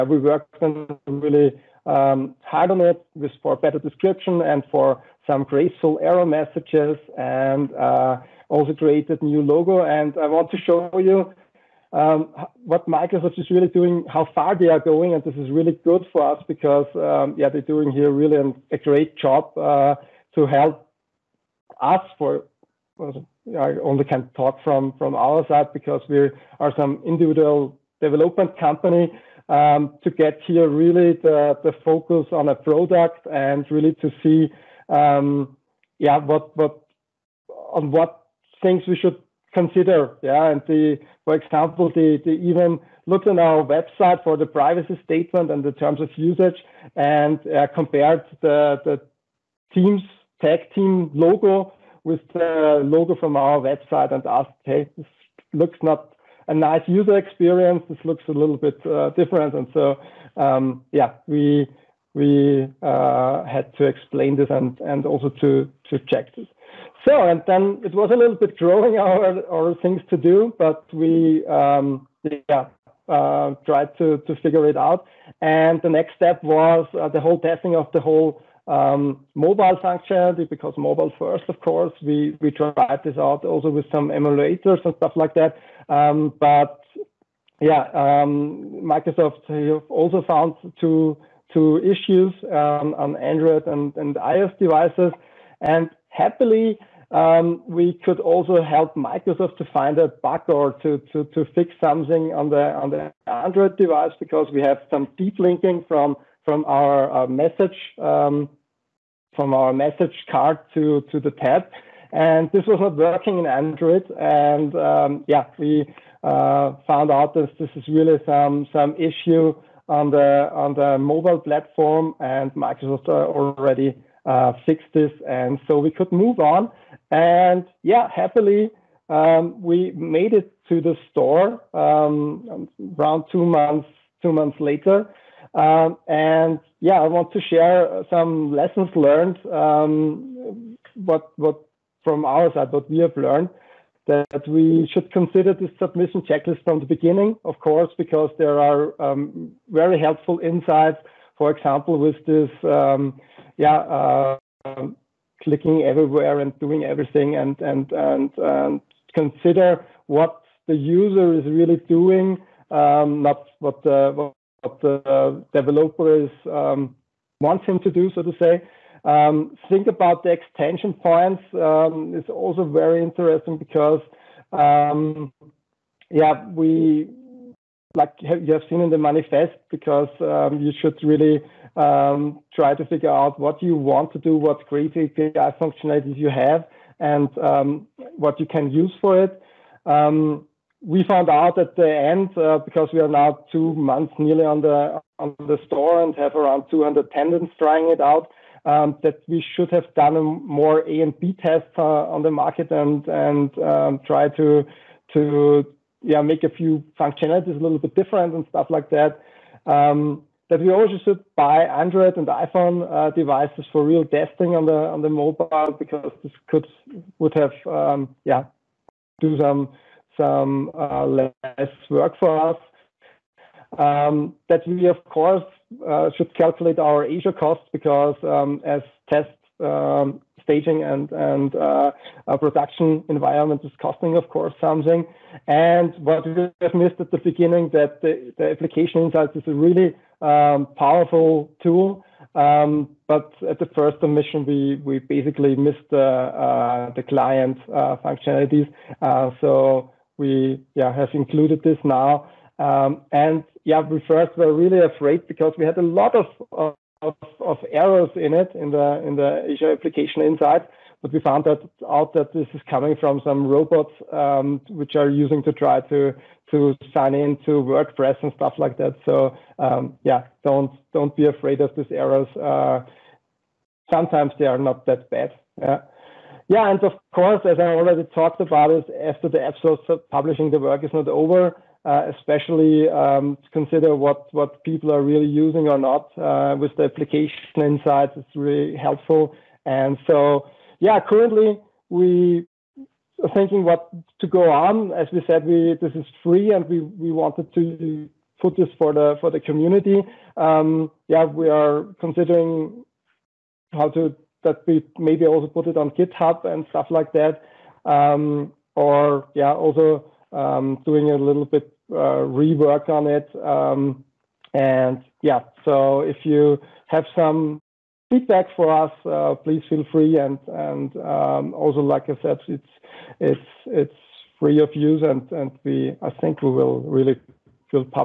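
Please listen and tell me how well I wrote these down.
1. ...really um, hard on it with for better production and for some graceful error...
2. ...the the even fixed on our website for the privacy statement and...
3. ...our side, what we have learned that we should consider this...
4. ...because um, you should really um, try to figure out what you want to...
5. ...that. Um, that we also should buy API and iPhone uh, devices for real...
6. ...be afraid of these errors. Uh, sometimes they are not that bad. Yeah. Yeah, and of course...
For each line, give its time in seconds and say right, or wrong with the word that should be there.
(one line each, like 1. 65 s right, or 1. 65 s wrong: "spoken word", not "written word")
1. 1 s wrong: "description", not "production"
2. 41 s wrong: "looked", not "fixed"
3. 142 s right
4. 179 s right
5. 208 s wrong: "Android", not "API"
6. 271 s right.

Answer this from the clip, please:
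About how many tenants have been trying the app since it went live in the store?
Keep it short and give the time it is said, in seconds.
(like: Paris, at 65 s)
200, at 196 s.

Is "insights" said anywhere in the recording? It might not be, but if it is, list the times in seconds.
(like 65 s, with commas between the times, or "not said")
150 s, 239 s, 260 s, 287 s.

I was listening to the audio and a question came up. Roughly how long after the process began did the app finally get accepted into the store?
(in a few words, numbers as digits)
2 months.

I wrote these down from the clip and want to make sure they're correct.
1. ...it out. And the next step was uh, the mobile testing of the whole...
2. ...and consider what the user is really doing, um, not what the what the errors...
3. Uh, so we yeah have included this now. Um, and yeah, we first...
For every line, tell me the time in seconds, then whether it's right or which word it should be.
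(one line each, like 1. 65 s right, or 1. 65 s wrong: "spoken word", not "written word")
1. 74 s wrong: "whole", not "mobile"
2. 158 s wrong: "developers", not "errors"
3. 248 s right.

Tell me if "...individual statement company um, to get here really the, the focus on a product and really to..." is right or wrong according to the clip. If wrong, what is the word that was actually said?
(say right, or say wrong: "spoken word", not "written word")
wrong: "development", not "statement".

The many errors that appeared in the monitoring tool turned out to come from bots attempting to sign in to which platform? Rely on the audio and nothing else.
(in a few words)
WordPress.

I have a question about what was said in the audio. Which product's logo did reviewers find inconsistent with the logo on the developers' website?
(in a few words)
TagTeam.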